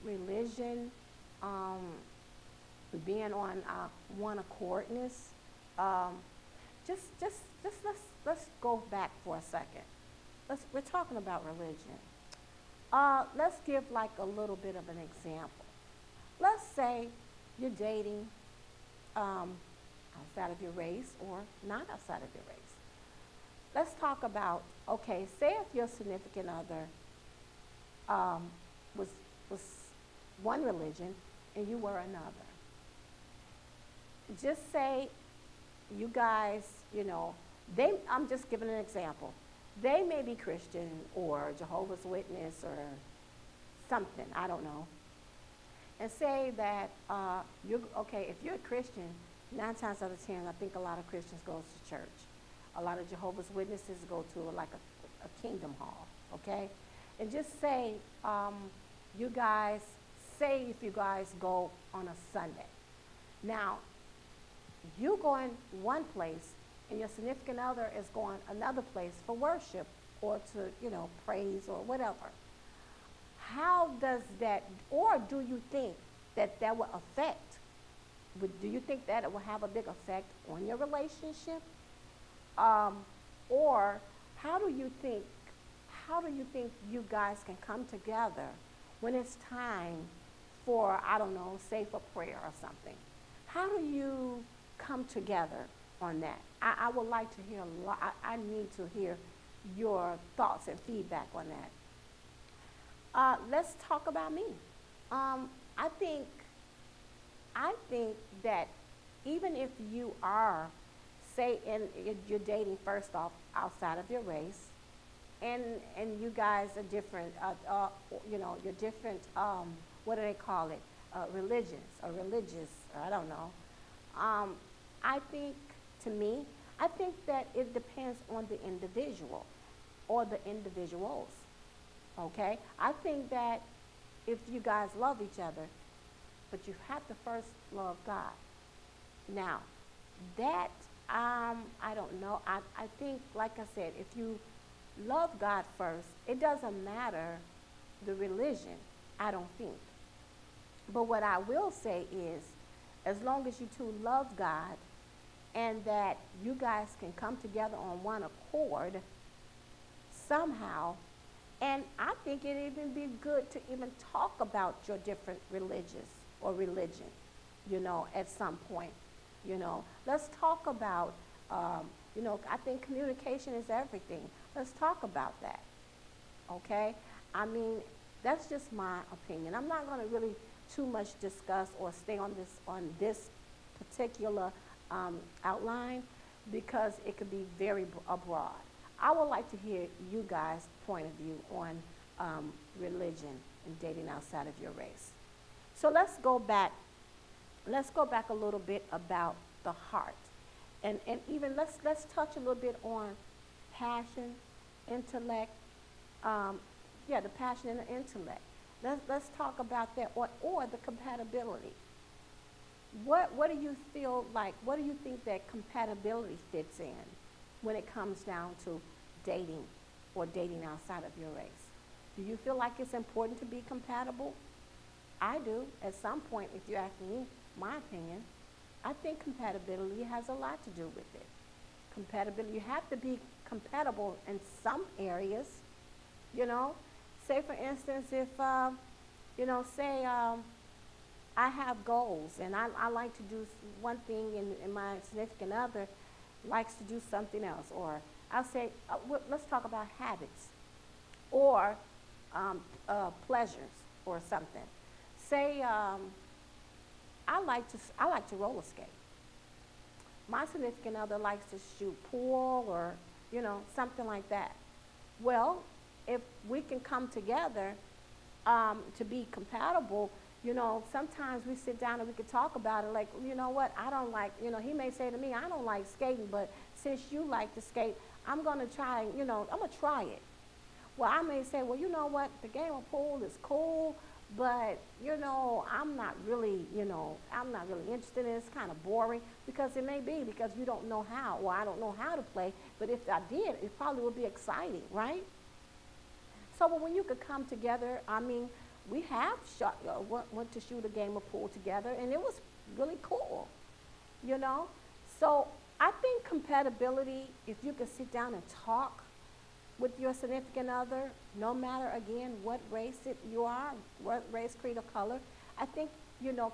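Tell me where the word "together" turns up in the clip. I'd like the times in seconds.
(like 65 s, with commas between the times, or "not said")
87 s, 95 s, 157 s, 267 s, 297 s, 301 s.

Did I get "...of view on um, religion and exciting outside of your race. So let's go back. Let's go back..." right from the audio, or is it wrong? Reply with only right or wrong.
wrong.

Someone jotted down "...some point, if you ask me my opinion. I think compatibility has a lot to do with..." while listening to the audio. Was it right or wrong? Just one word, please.
right.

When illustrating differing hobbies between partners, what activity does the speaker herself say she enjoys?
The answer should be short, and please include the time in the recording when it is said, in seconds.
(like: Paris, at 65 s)
roller skate, at 258 s.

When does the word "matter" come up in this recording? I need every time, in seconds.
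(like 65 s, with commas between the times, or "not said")
146 s, 311 s.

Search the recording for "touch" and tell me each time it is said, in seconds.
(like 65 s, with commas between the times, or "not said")
202 s.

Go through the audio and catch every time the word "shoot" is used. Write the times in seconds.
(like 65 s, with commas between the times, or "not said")
261 s, 300 s.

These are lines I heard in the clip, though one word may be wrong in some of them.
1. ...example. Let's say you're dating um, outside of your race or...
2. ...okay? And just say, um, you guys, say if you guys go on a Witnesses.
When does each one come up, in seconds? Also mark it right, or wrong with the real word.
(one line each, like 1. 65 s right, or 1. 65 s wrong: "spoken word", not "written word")
1. 14 s right
2. 56 s wrong: "Sunday", not "Witnesses".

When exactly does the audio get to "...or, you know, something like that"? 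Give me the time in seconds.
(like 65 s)
262 s.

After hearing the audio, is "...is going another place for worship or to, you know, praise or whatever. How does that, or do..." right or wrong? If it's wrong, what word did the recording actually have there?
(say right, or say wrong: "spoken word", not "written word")
right.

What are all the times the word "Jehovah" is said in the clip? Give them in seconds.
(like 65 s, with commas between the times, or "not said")
41 s, 53 s.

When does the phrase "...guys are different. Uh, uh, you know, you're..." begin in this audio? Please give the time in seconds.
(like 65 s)
116 s.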